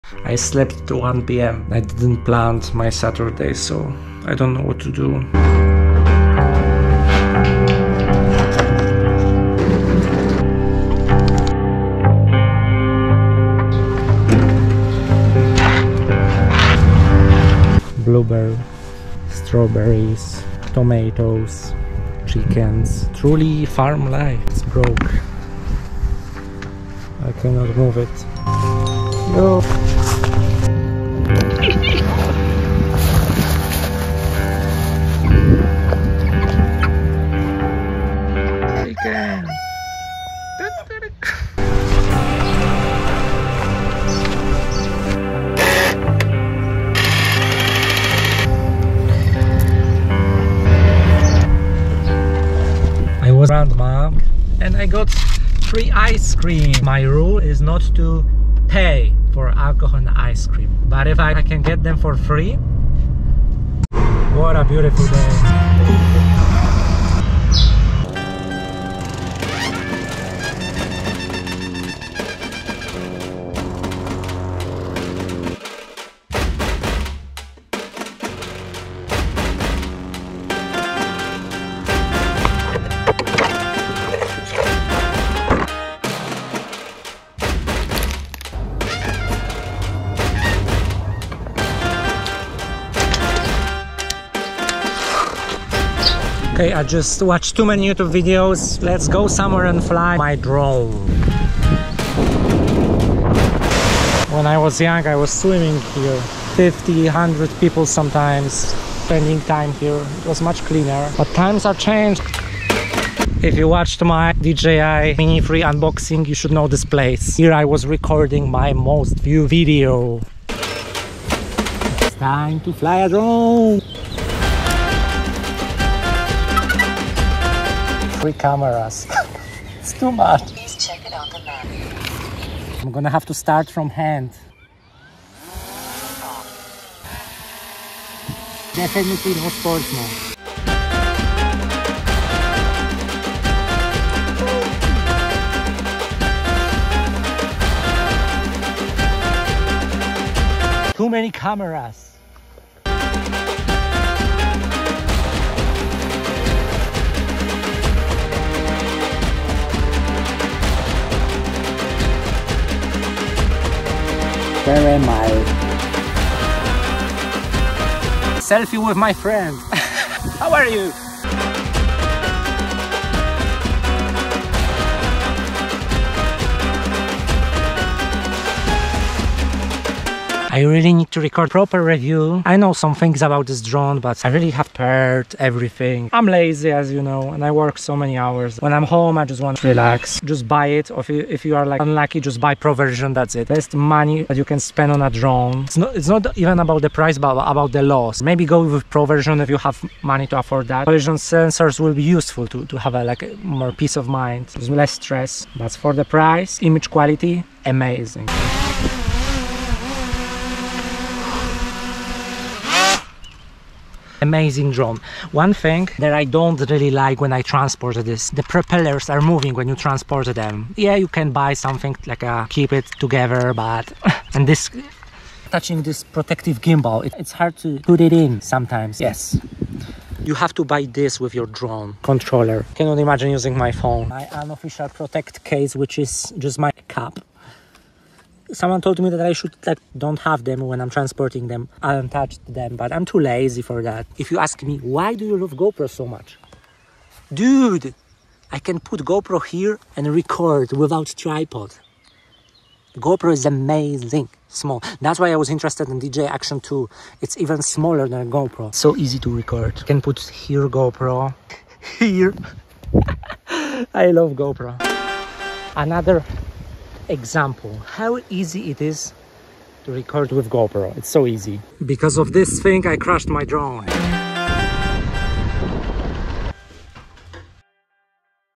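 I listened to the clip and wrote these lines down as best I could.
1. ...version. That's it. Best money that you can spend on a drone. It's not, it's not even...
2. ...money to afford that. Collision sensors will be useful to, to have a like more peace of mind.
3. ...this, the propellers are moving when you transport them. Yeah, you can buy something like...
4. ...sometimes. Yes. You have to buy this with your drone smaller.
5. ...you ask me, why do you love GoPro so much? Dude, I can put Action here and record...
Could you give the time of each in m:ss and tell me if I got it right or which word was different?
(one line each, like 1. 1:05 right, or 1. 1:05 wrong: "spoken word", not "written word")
1. 3:12 right
2. 3:20 right
3. 3:38 right
4. 3:48 wrong: "controller", not "smaller"
5. 4:04 wrong: "GoPro", not "Action".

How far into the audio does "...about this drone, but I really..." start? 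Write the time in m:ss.
3:03.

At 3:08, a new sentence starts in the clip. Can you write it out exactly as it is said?
When I'm home, I just want to relax.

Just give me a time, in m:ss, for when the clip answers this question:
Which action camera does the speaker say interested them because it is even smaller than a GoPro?
4:16.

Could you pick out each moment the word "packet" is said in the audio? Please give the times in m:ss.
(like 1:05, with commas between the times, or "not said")
not said.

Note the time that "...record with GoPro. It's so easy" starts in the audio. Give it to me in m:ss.
4:29.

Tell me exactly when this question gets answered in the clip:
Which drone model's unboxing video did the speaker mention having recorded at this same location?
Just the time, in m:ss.
1:54.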